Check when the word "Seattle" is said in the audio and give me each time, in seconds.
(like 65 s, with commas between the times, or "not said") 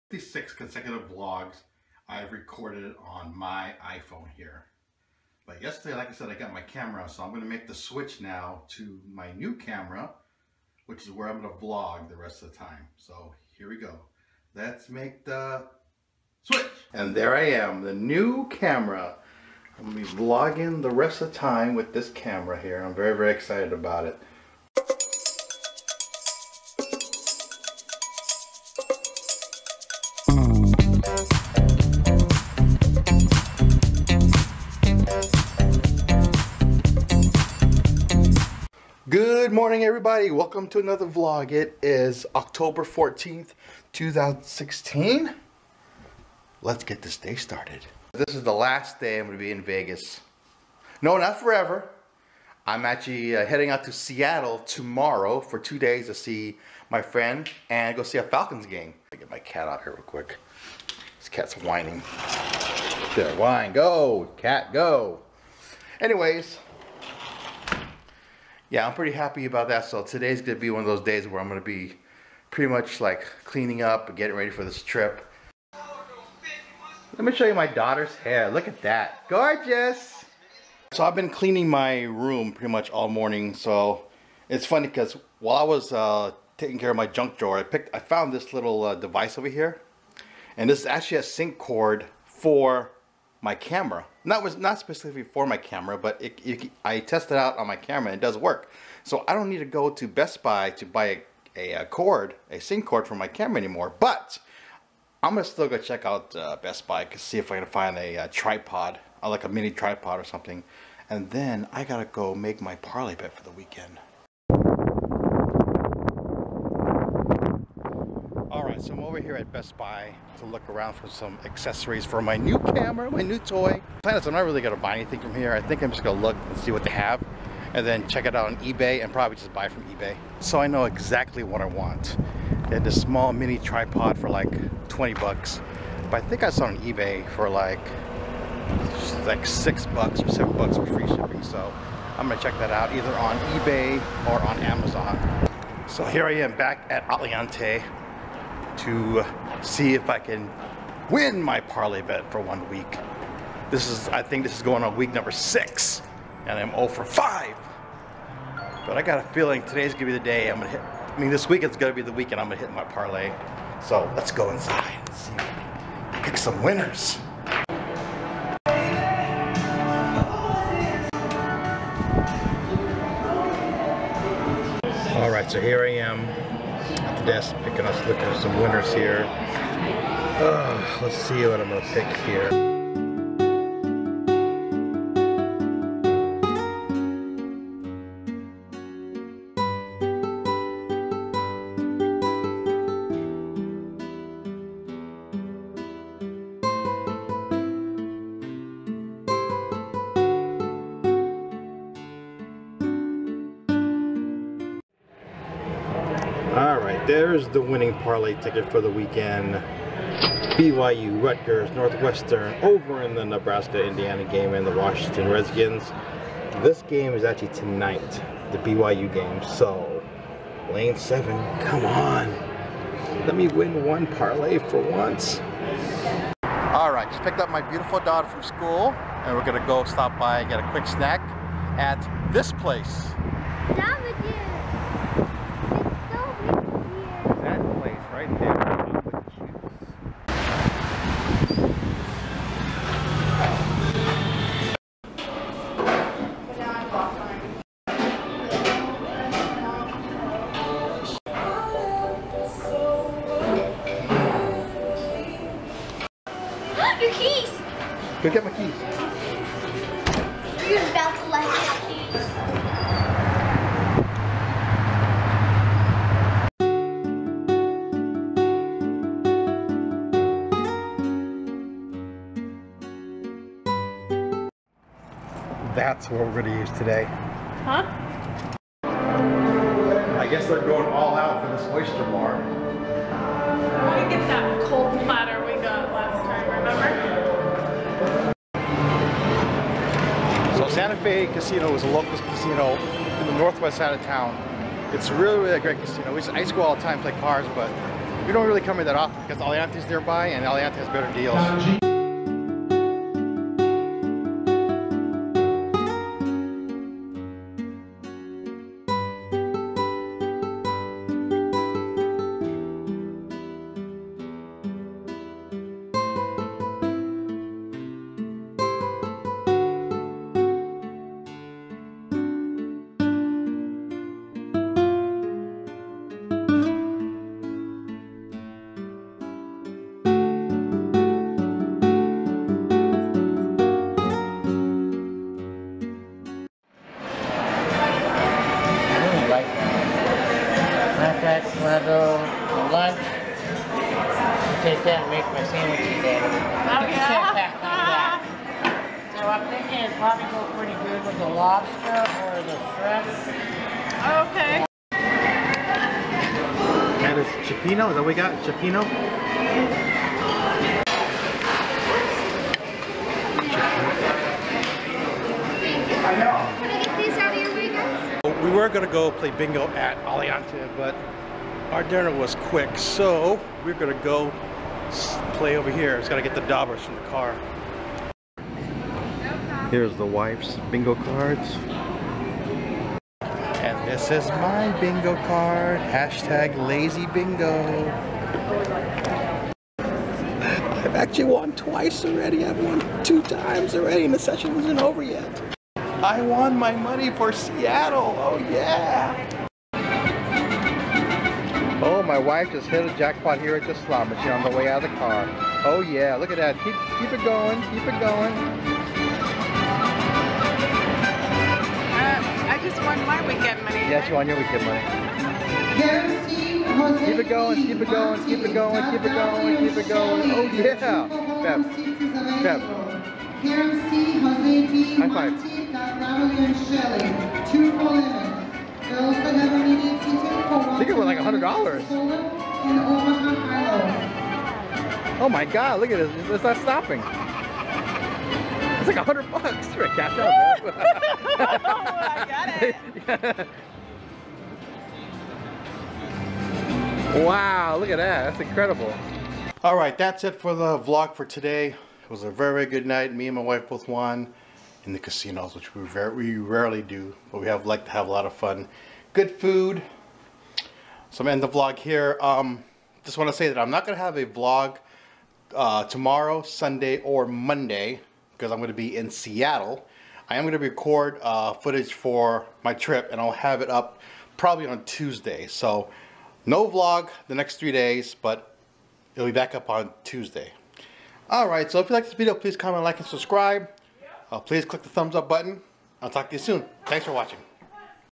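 53 s, 397 s, 469 s.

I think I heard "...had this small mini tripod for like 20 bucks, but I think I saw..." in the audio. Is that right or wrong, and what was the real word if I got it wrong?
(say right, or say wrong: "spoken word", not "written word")
right.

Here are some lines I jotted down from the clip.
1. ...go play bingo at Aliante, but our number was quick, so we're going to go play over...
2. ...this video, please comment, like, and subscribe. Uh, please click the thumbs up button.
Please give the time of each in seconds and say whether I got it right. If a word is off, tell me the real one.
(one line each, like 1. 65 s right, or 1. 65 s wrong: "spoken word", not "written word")
1. 368 s wrong: "dinner", not "number"
2. 482 s right.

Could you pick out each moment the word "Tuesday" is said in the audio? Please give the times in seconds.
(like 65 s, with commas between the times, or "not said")
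474 s, 480 s.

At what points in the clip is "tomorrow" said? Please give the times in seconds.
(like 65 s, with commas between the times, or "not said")
54 s, 465 s.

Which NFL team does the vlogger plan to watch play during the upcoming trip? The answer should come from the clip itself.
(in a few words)
Falcons.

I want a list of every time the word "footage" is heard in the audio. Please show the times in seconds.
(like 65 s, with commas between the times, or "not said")
471 s.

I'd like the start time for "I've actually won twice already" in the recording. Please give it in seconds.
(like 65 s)
389 s.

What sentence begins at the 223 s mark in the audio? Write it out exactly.
Let me win one parlay for once.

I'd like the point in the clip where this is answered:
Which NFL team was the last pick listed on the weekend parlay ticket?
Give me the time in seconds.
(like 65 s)
214 s.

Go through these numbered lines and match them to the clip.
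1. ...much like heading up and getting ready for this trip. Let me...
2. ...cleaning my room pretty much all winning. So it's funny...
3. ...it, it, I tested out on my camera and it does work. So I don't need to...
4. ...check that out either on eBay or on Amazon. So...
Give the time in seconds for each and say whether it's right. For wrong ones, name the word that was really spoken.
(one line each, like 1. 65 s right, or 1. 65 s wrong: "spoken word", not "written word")
1. 72 s wrong: "cleaning", not "heading"
2. 81 s wrong: "morning", not "winning"
3. 96 s right
4. 142 s right.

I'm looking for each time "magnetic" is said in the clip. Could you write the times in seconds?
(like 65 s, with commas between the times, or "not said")
not said.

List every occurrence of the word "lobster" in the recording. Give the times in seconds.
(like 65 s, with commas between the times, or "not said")
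351 s.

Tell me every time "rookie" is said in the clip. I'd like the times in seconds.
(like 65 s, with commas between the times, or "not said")
not said.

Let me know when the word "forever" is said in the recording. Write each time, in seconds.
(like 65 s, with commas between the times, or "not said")
51 s.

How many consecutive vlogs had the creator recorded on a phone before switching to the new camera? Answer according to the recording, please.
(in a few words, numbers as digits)
56.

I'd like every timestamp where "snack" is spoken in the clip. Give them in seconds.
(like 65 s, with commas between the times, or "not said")
230 s.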